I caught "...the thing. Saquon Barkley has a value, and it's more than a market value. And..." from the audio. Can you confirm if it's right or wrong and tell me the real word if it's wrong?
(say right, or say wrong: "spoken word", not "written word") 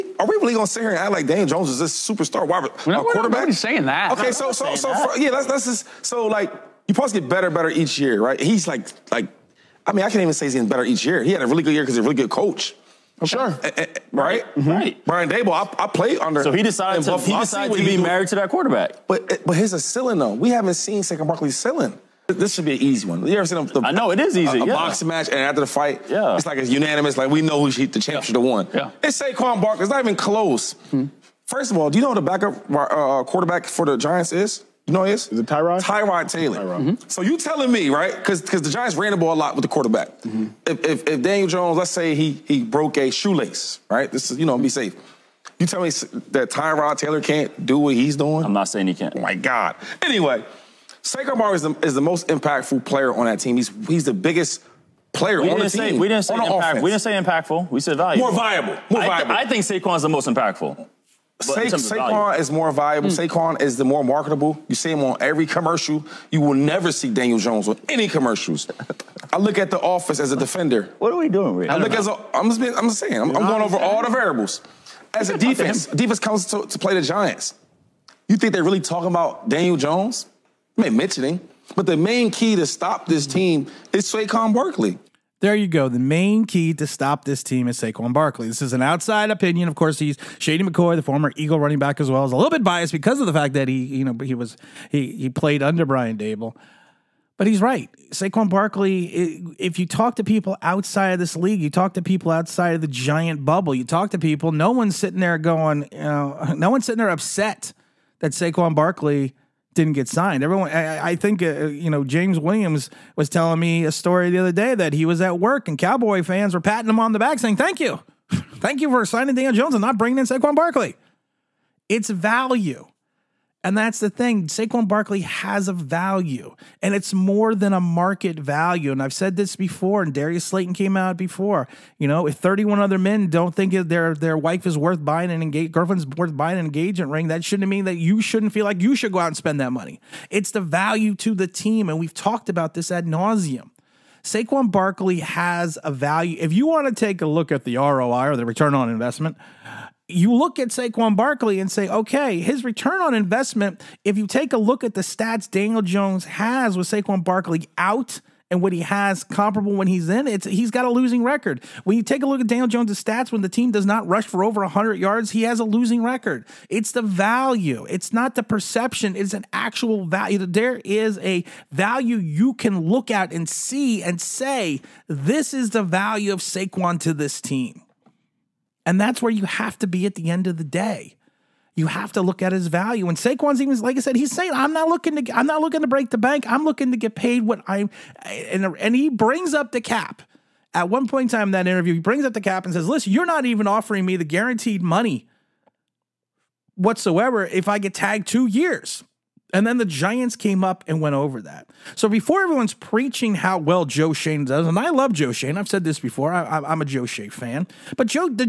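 right.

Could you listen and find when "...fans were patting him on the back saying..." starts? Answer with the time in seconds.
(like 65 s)
116 s.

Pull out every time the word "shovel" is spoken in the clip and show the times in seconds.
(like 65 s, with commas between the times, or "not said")
not said.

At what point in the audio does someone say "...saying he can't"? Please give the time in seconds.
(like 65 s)
48 s.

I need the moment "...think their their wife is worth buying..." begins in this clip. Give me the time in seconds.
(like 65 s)
133 s.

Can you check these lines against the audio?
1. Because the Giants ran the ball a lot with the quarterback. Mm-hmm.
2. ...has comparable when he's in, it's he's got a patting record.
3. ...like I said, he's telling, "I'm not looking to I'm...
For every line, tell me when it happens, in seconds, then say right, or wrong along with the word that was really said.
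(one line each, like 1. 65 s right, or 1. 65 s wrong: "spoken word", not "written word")
1. 38 s right
2. 158 s wrong: "losing", not "patting"
3. 183 s wrong: "saying", not "telling".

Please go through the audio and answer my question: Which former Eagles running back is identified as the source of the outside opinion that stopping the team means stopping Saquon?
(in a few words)
Shady McCoy.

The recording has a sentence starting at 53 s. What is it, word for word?
He's he's the biggest player we on the team.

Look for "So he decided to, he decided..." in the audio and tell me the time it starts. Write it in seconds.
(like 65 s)
16 s.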